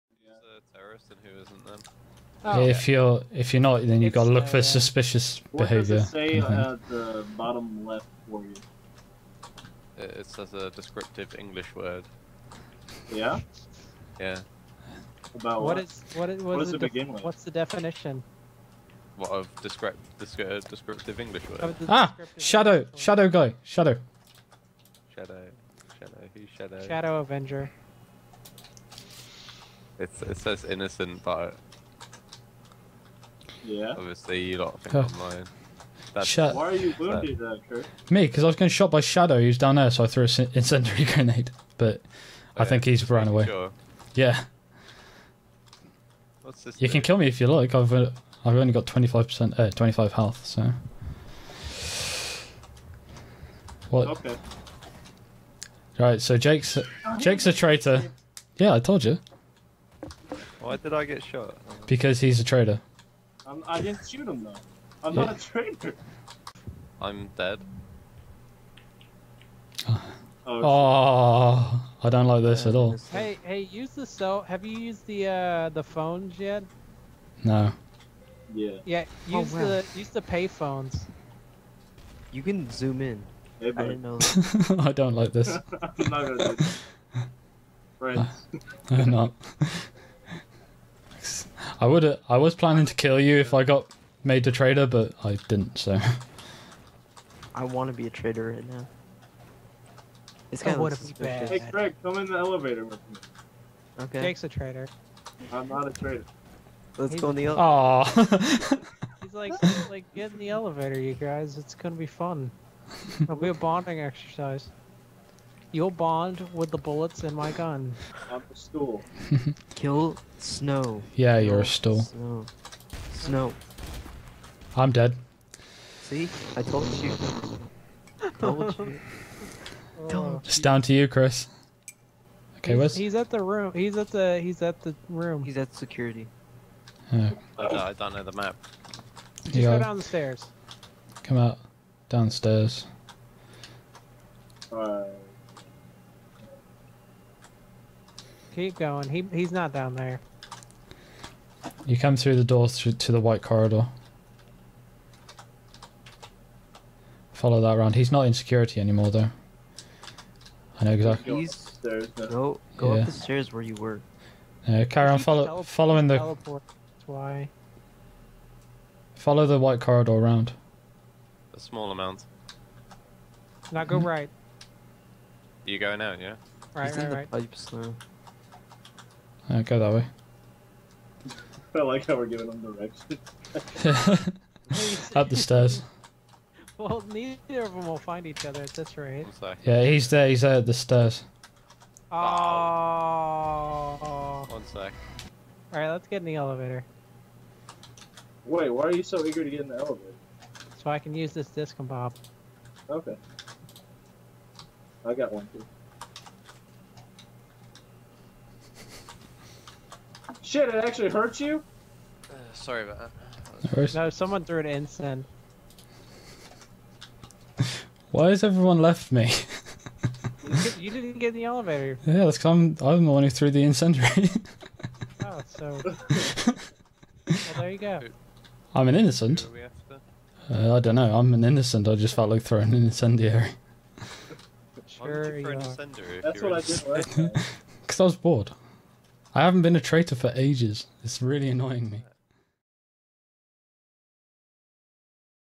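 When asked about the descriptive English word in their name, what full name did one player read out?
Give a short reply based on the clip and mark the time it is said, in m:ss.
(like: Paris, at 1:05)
Shadow Avenger, at 0:26.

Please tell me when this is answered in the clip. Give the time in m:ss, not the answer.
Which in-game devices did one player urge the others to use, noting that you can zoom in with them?
1:20.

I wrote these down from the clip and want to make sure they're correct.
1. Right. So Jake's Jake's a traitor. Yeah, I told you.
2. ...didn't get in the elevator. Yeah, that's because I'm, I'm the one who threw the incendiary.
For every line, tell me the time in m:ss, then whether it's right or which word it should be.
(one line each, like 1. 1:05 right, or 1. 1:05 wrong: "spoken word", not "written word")
1. 0:55 right
2. 3:40 right.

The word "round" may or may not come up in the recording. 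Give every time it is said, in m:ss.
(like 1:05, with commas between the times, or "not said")
2:37, 2:50.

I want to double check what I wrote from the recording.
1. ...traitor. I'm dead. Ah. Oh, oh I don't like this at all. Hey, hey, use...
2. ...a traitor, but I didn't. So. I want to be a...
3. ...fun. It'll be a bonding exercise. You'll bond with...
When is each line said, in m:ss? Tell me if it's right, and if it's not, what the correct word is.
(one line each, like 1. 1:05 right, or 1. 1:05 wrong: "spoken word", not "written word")
1. 1:05 right
2. 1:34 right
3. 1:52 right.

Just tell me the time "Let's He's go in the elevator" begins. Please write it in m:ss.
1:46.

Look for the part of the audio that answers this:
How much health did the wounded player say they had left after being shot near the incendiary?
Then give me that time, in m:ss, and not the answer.
0:49.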